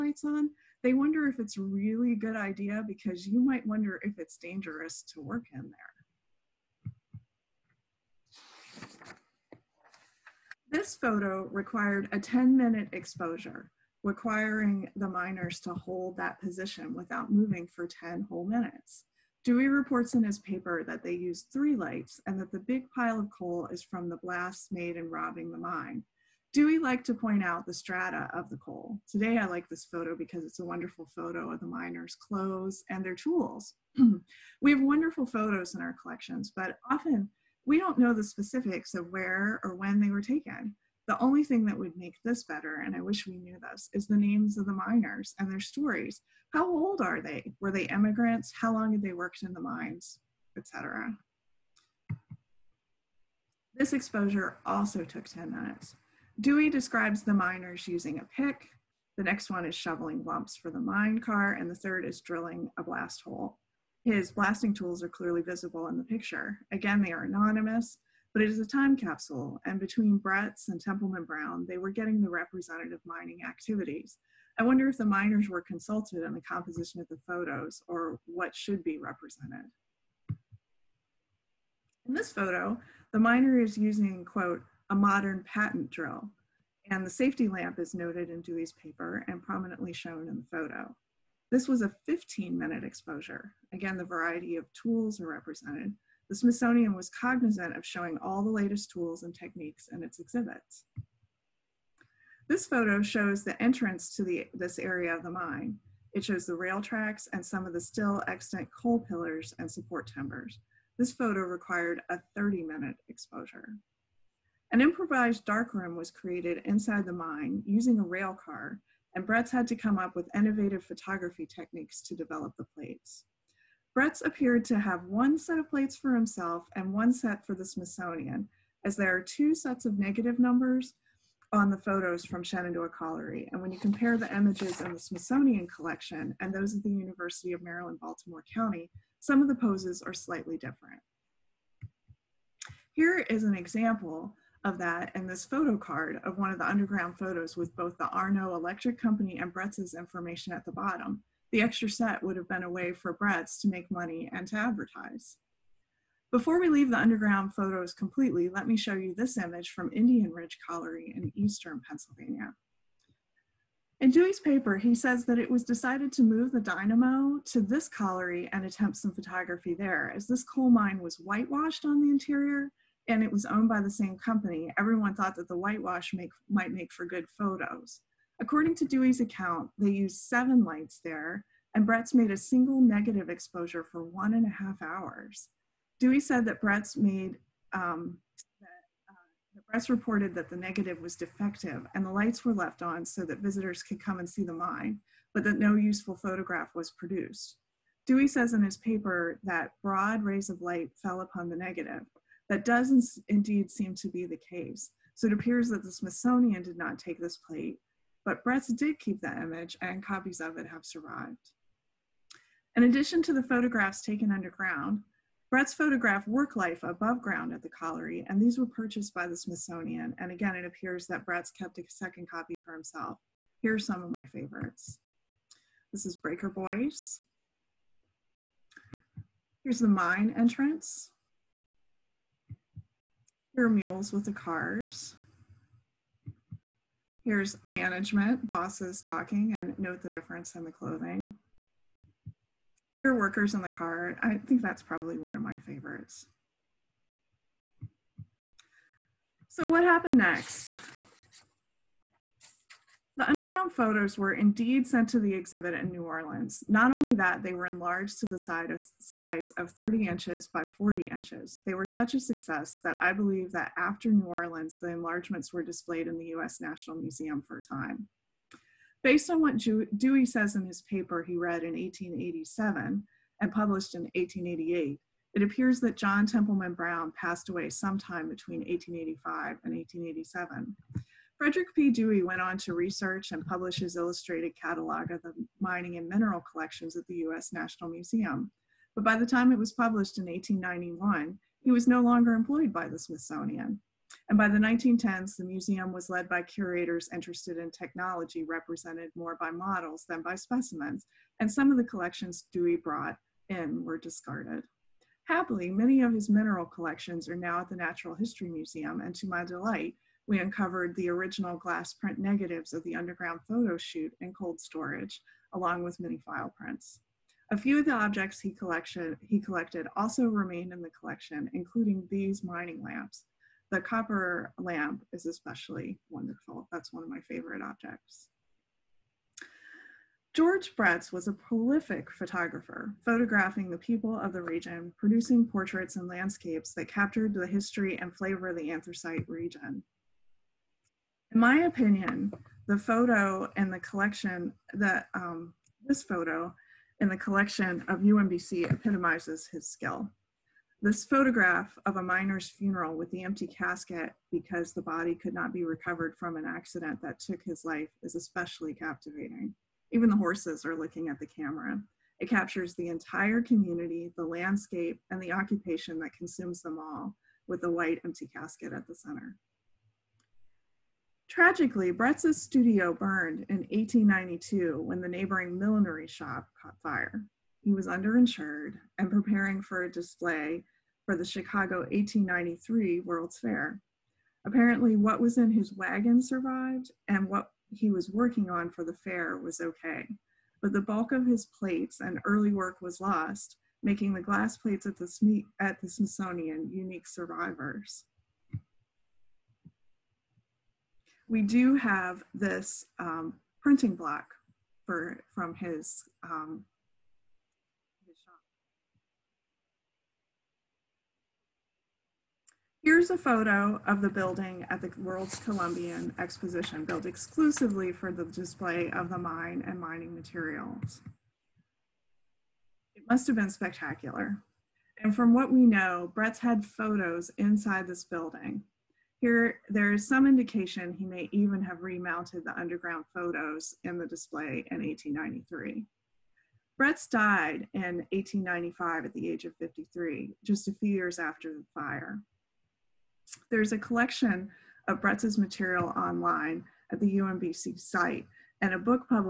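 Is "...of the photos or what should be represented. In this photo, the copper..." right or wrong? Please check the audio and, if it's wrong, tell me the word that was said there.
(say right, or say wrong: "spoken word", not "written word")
wrong: "miner", not "copper".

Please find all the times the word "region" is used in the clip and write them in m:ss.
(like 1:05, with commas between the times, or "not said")
5:34, 5:39.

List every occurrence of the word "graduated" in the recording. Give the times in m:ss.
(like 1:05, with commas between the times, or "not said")
not said.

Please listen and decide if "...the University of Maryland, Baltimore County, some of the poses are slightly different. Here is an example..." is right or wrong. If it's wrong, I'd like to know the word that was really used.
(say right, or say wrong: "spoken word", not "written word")
right.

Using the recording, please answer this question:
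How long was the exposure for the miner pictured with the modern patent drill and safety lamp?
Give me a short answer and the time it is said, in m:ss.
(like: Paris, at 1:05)
15 minutes, at 1:31.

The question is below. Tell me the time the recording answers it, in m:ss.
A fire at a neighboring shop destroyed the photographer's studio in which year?
6:11.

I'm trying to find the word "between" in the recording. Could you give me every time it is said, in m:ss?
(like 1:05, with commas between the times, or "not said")
1:09, 4:38.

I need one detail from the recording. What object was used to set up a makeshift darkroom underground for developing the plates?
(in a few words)
a rail car.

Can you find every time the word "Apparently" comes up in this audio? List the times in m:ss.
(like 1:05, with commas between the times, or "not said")
6:24.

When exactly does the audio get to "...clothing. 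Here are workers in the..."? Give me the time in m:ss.
4:00.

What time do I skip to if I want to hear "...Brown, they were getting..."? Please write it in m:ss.
1:11.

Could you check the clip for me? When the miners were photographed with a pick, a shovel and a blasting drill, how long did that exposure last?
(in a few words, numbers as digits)
10 minutes.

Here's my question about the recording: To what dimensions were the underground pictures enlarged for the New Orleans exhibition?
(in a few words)
30 by 40 inches.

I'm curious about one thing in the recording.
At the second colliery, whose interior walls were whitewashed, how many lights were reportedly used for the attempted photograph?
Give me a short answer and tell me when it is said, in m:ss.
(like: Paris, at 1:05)
7, at 2:59.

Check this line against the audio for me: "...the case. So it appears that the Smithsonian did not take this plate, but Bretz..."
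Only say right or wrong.
right.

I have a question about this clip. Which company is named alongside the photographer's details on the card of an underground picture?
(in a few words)
Arno Electric Company.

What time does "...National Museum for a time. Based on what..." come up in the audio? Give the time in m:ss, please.
4:26.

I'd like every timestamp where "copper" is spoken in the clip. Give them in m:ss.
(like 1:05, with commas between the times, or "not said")
5:23.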